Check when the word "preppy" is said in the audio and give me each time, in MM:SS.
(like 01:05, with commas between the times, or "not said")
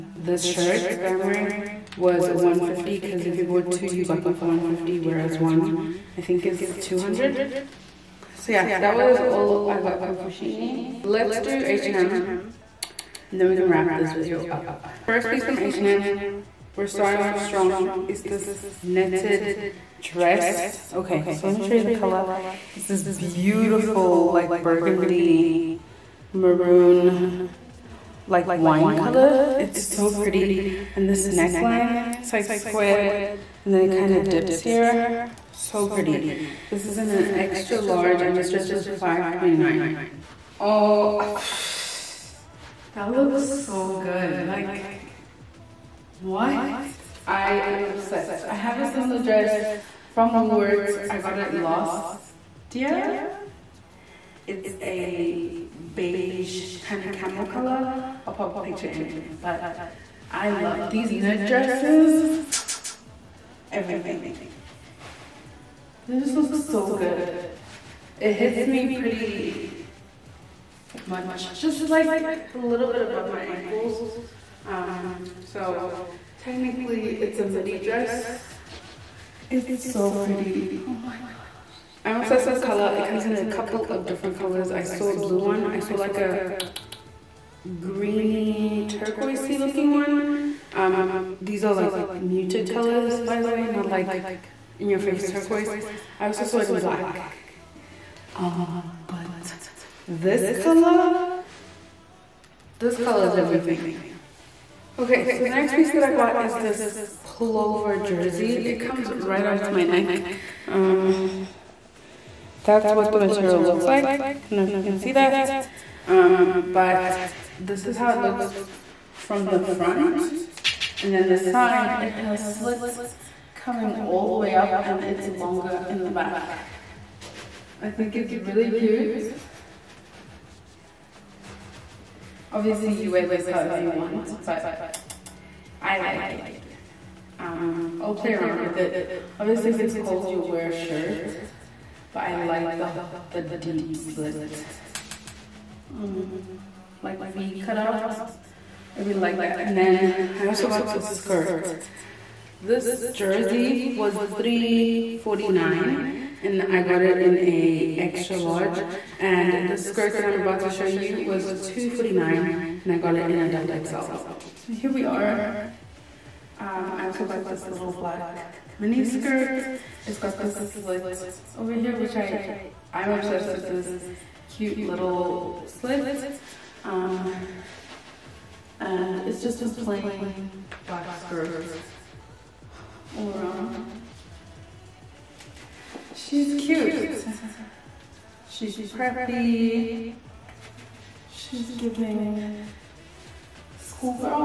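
03:08.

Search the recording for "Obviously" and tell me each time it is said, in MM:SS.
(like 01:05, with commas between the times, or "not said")
02:12, 02:19.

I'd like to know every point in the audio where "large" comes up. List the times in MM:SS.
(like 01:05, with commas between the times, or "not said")
00:37, 02:38.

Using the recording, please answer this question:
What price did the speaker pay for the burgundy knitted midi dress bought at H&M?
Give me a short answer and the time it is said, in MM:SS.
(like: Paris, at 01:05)
5.29, at 00:38.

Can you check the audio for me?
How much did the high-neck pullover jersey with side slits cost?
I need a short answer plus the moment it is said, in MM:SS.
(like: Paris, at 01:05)
349, at 02:34.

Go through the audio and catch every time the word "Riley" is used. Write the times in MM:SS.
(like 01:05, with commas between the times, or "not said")
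not said.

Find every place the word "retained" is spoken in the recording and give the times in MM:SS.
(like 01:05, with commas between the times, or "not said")
not said.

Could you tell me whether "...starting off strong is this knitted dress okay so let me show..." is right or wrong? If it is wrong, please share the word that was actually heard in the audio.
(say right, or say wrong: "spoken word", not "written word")
right.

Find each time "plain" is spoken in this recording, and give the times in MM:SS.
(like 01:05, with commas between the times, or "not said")
02:59.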